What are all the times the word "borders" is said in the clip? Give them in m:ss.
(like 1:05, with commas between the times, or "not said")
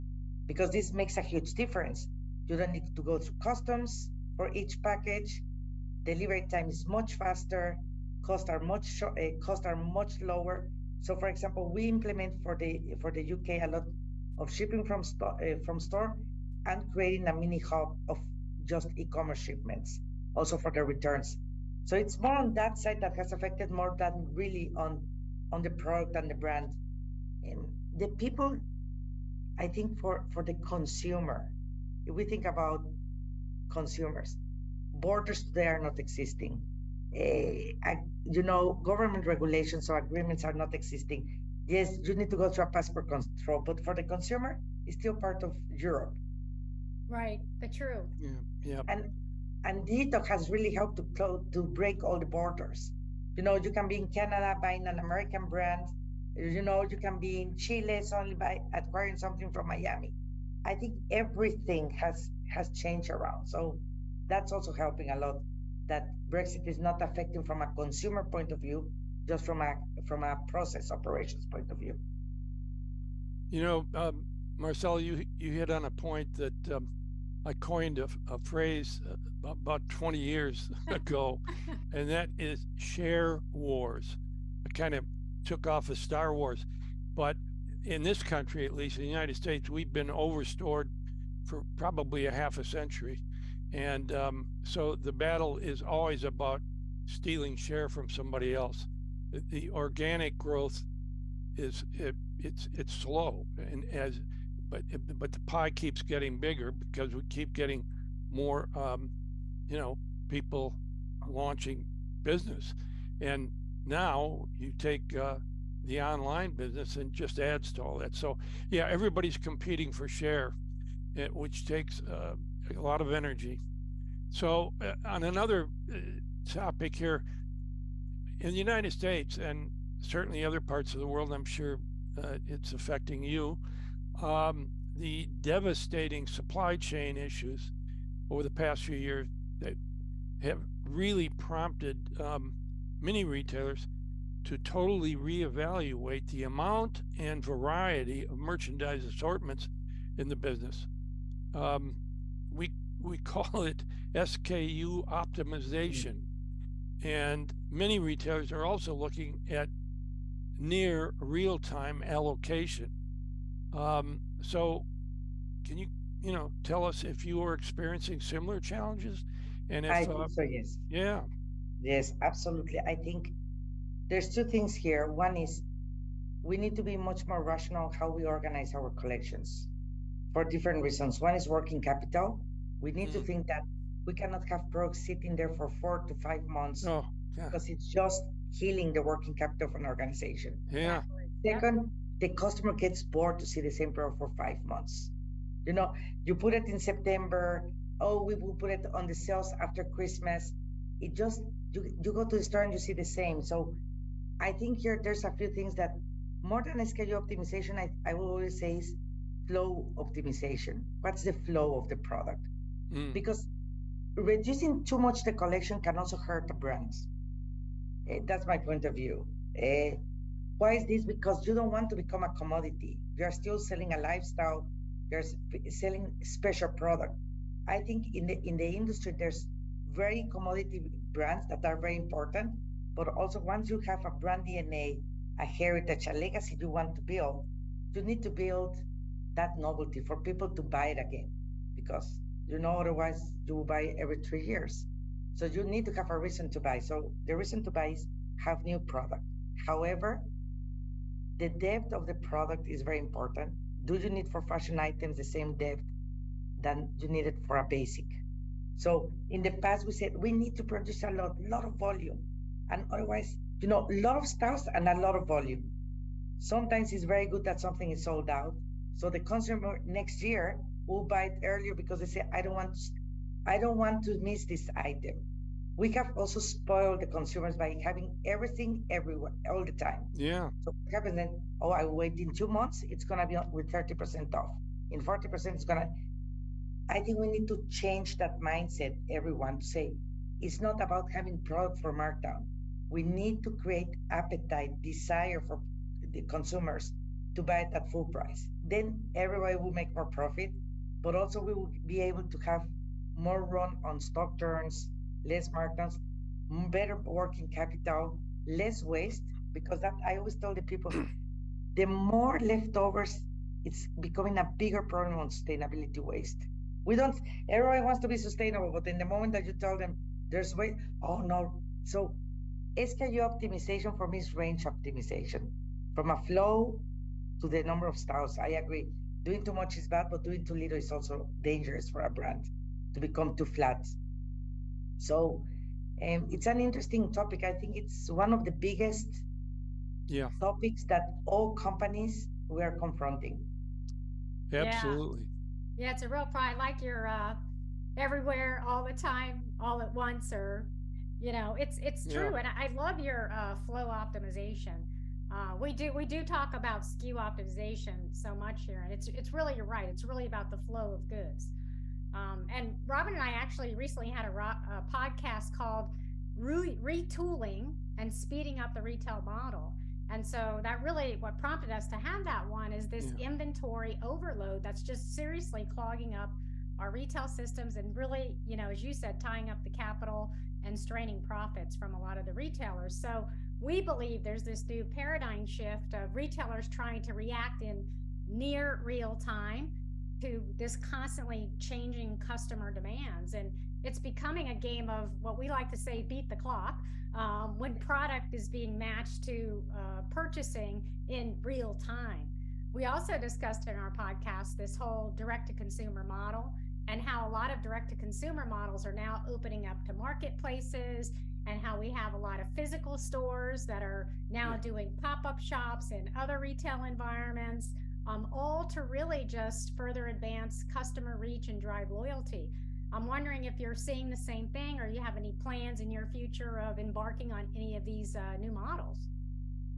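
0:34, 0:52.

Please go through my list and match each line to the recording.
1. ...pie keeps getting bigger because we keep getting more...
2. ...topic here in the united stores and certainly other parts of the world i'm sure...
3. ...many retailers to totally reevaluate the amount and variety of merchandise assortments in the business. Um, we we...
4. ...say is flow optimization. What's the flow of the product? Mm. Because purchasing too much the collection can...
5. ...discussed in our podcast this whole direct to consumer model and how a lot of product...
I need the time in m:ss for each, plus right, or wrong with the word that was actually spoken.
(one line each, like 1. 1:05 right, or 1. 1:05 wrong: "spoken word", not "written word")
1. 1:45 right
2. 2:06 wrong: "states", not "stores"
3. 2:23 right
4. 3:28 wrong: "reducing", not "purchasing"
5. 6:43 wrong: "direct", not "product".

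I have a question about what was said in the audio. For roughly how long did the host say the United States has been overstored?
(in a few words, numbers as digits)
half a century.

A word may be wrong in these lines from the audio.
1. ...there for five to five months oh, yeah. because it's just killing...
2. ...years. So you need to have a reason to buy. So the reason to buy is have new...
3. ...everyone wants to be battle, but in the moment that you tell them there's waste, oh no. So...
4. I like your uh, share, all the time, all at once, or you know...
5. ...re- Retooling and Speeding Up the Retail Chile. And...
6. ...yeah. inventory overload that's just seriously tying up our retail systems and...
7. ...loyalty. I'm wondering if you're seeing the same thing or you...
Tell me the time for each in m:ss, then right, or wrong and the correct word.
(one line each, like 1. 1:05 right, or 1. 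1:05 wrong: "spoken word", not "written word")
1. 3:05 wrong: "four", not "five"
2. 4:04 right
3. 5:17 wrong: "sustainable", not "battle"
4. 5:46 wrong: "everywhere", not "share"
5. 6:06 wrong: "Model", not "Chile"
6. 6:13 wrong: "clogging", not "tying"
7. 7:01 right.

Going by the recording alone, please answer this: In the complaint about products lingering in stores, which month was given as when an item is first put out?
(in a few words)
September.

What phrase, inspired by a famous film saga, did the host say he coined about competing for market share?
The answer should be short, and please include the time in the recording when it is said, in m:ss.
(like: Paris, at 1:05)
share wars, at 1:22.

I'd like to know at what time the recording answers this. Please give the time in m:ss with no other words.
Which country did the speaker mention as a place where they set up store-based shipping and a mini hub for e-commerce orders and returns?
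0:13.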